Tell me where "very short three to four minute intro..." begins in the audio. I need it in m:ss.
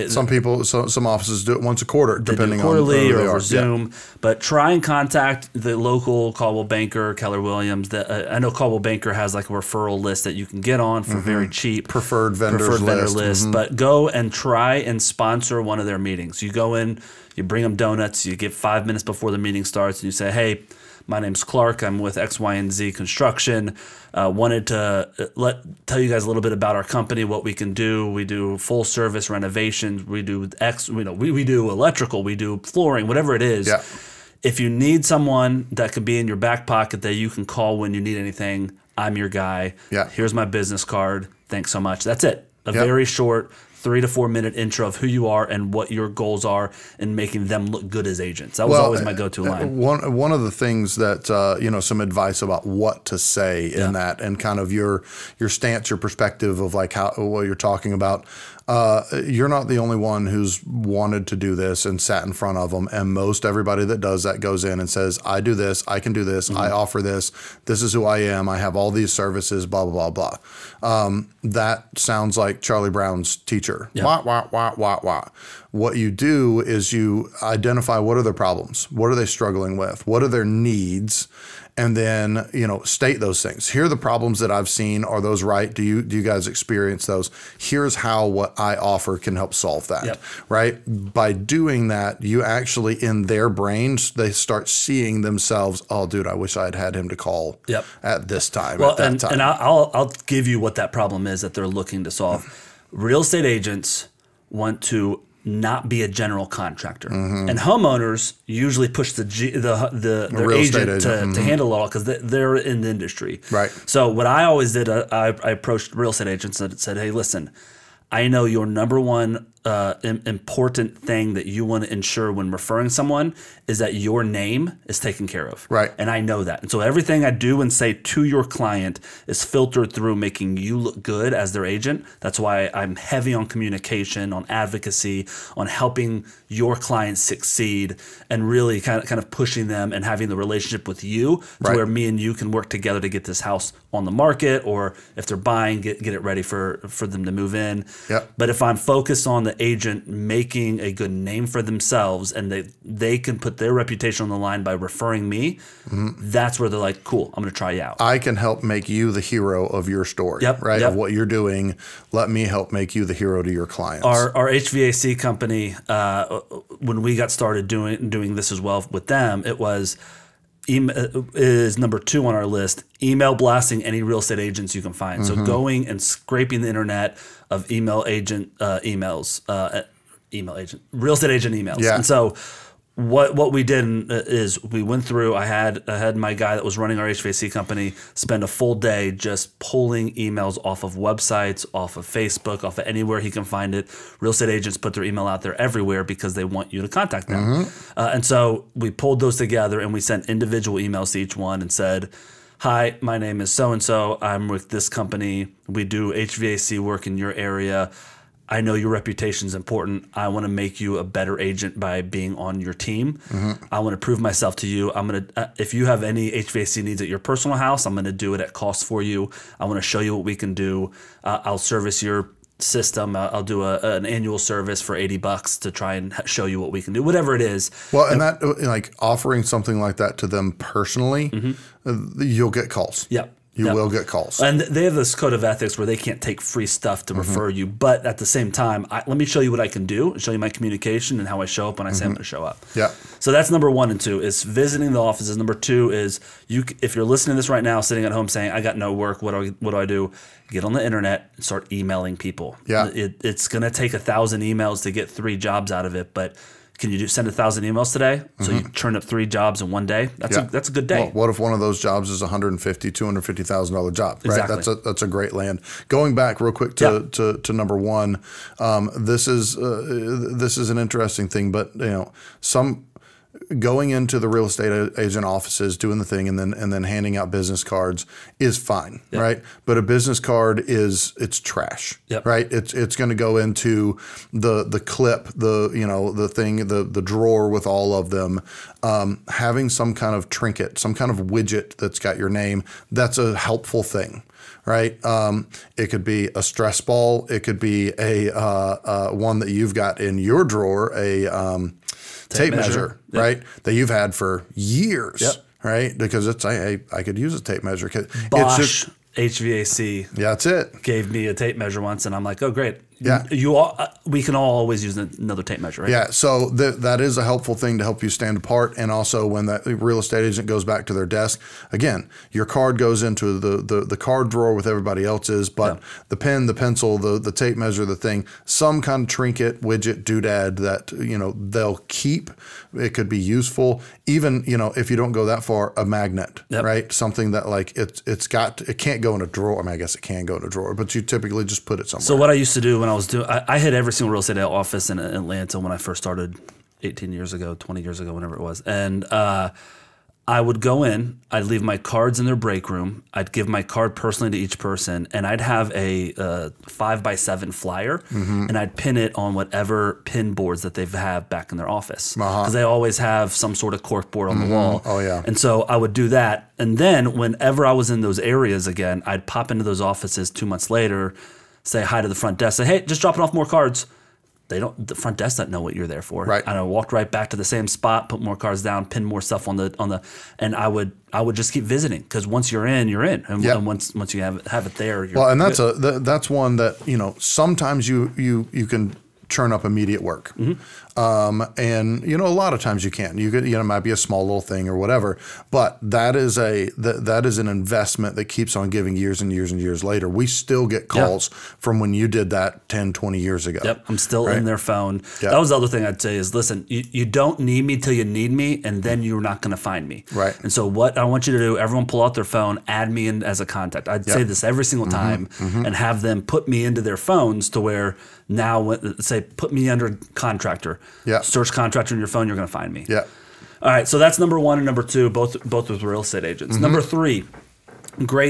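0:42.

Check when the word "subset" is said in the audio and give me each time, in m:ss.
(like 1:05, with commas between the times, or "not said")
not said.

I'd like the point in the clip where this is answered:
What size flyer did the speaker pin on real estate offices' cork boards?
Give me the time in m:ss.
5:56.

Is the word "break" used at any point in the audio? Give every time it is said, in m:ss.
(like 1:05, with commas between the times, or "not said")
5:52.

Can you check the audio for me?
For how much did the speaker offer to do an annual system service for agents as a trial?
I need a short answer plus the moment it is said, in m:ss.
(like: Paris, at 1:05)
$80, at 3:44.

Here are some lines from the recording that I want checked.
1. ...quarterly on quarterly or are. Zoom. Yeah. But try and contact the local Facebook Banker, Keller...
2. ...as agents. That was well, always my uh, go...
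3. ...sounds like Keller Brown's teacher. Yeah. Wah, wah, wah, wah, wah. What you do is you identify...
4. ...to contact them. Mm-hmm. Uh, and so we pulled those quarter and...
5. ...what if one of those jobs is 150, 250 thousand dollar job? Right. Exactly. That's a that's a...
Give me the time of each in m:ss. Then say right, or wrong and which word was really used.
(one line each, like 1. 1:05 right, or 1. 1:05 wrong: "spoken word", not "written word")
1. 0:02 wrong: "Coldwell", not "Facebook"
2. 0:48 right
3. 1:11 wrong: "Charlie", not "Keller"
4. 3:16 wrong: "together", not "quarter"
5. 4:21 right.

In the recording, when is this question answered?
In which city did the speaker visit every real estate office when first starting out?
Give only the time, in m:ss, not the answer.
5:44.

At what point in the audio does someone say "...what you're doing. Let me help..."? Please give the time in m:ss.
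2:40.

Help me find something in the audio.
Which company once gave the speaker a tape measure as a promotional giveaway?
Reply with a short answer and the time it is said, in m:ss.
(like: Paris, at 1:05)
Bosch, at 5:08.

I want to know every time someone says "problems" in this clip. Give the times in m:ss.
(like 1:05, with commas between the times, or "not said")
1:18, 1:23, 1:40.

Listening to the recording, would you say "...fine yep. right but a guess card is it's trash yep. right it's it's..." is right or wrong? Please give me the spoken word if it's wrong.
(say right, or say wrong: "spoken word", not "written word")
wrong: "business", not "guess".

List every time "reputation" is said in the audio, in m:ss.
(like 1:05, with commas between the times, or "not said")
2:33, 3:28.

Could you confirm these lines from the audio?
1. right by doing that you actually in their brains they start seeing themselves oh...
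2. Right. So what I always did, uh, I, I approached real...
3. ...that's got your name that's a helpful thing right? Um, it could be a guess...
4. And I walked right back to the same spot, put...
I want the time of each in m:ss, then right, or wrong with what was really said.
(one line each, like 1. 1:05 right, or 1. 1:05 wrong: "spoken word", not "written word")
1. 1:30 right
2. 1:53 right
3. 4:51 wrong: "stress", not "guess"
4. 6:16 right.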